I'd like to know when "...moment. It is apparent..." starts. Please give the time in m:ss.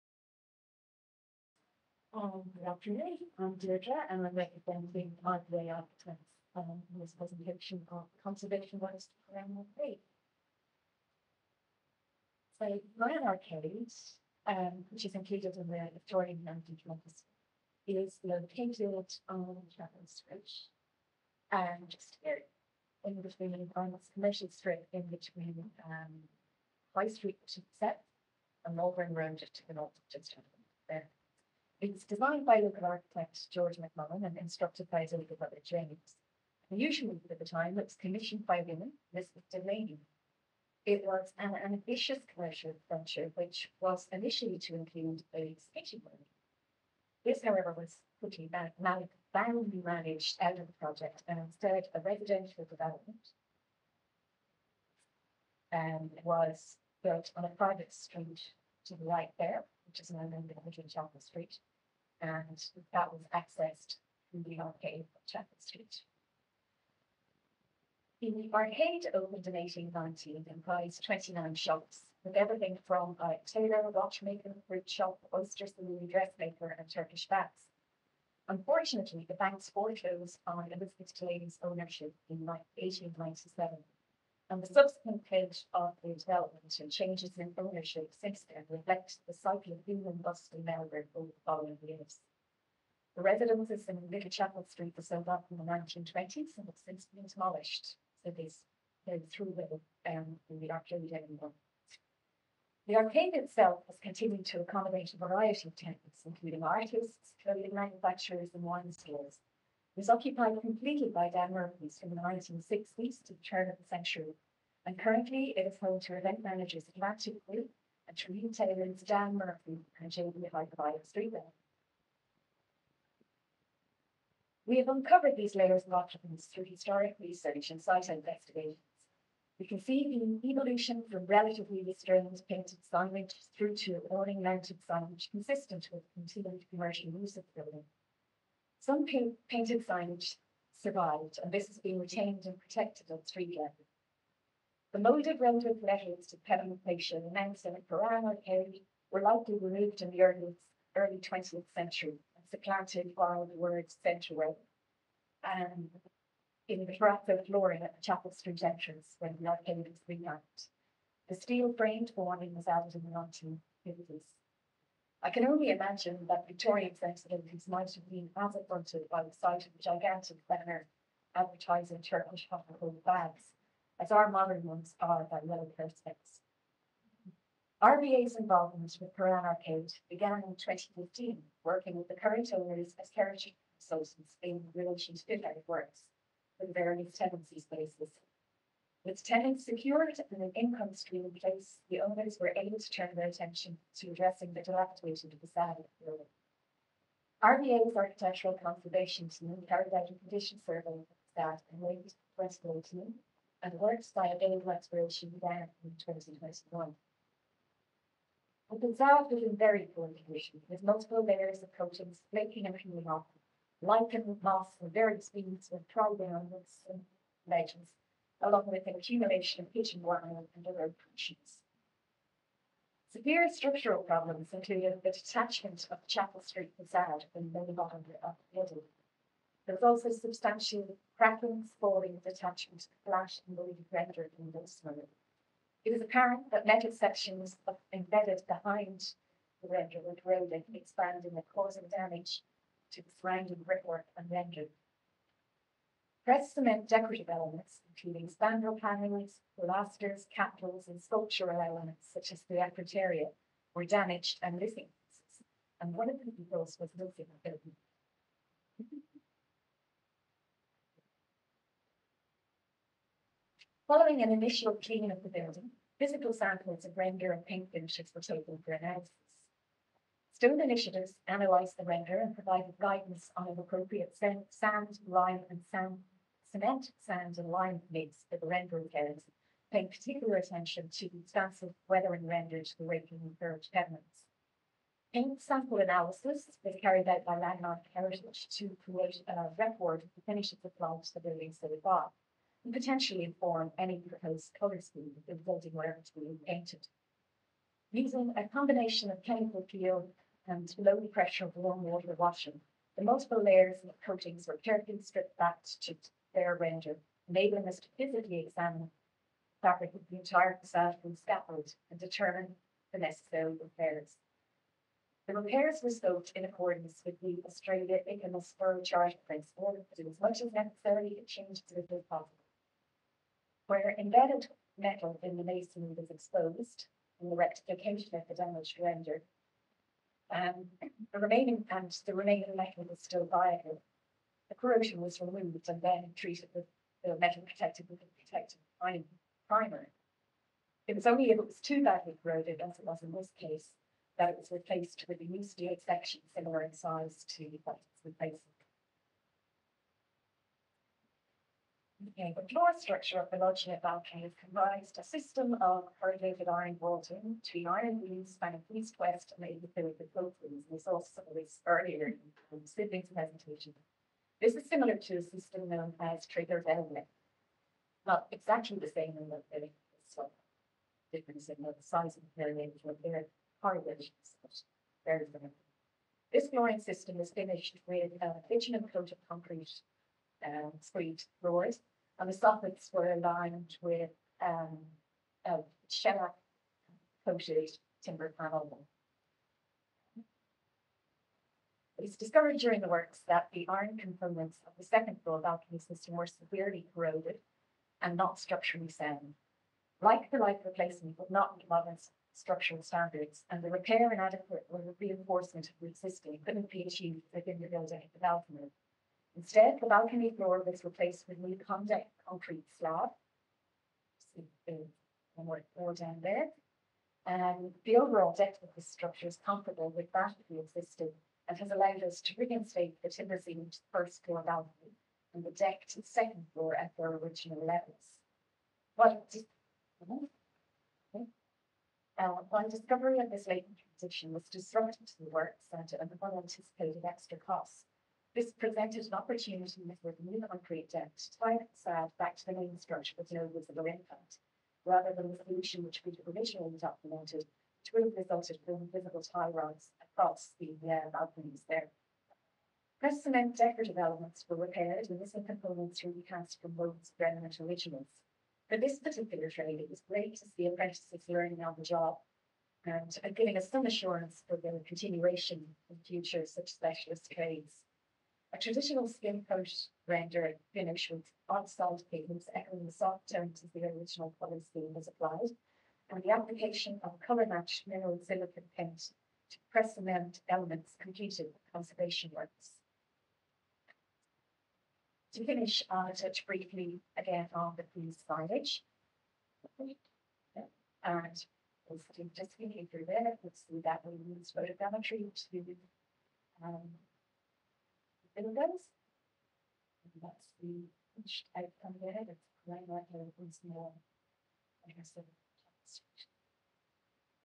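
3:54.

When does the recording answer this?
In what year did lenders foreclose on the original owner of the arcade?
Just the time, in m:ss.
1:22.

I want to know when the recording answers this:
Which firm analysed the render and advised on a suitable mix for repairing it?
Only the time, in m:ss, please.
4:30.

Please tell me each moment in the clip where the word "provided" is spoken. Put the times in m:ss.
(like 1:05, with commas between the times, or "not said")
4:32.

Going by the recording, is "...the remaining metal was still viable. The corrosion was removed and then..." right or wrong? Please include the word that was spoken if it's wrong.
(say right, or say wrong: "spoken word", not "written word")
right.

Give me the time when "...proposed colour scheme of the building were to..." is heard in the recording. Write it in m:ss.
4:53.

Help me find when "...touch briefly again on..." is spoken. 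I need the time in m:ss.
8:06.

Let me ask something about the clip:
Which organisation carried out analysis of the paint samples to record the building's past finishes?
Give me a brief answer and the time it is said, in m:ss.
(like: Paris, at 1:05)
Landmark Heritage, at 4:47.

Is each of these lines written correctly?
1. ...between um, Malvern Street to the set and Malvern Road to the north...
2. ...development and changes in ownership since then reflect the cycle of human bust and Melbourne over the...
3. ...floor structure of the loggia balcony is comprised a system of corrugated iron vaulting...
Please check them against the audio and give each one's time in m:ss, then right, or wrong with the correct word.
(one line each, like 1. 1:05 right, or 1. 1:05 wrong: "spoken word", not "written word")
1. 0:25 wrong: "High", not "Malvern"
2. 1:26 right
3. 5:52 right.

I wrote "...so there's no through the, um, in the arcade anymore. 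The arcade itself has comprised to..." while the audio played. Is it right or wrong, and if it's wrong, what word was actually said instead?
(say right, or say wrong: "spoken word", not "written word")
wrong: "continued", not "comprised".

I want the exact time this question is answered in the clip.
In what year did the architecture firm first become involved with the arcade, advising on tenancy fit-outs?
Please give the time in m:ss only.
3:00.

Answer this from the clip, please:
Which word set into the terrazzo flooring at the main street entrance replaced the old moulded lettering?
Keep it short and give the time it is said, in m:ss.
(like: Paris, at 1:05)
Centreway, at 2:34.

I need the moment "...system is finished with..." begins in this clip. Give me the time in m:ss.
6:16.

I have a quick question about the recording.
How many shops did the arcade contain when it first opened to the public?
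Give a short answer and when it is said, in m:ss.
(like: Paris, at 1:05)
29, at 1:11.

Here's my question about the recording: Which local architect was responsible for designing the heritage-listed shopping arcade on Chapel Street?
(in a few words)
George McMullen.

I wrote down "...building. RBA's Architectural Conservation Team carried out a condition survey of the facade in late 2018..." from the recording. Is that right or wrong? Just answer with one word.
right.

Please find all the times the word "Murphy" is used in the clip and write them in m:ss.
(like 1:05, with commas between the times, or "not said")
1:51, 1:59.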